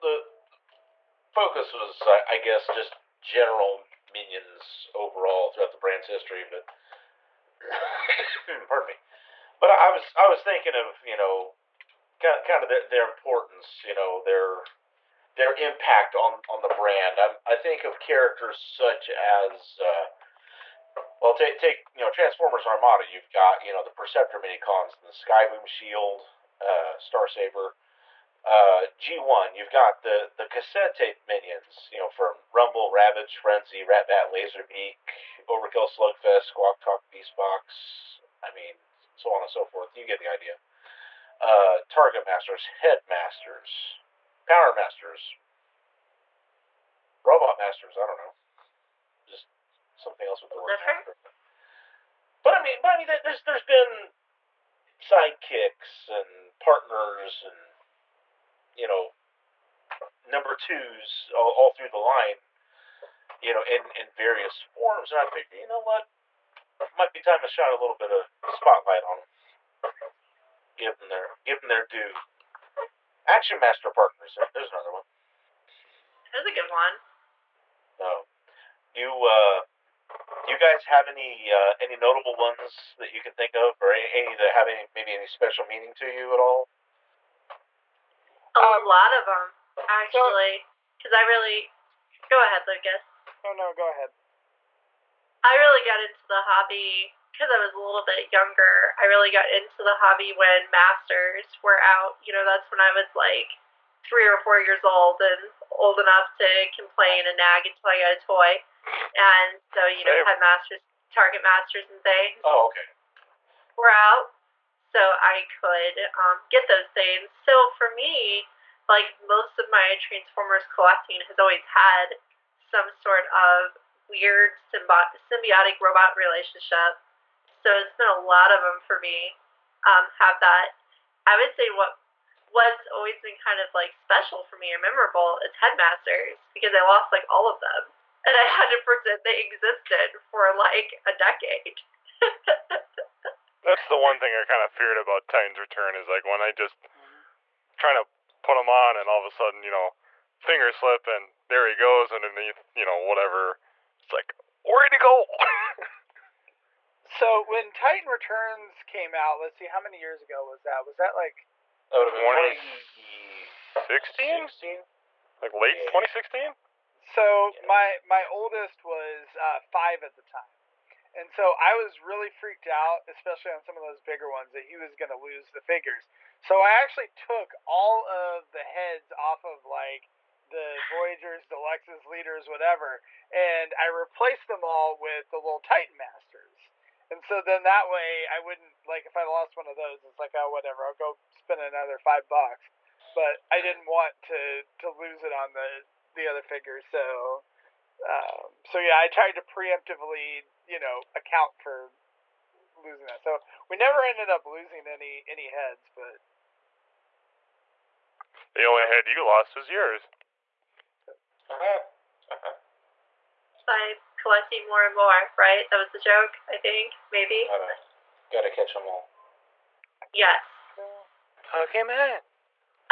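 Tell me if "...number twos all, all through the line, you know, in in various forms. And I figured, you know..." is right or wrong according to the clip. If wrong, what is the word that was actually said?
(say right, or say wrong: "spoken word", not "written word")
right.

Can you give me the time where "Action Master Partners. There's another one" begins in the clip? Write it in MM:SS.
01:13.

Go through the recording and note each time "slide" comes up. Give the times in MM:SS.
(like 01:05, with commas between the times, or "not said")
not said.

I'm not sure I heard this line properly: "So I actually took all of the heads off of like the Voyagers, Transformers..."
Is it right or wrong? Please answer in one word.
wrong.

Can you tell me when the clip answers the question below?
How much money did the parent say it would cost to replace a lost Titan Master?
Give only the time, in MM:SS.
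03:11.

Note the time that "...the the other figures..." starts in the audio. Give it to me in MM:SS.
03:15.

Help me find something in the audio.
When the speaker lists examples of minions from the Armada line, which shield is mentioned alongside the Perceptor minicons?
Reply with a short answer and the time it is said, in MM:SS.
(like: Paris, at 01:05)
Skyboom Shield, at 00:25.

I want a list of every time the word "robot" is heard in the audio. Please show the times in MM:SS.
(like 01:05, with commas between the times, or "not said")
00:47, 02:05.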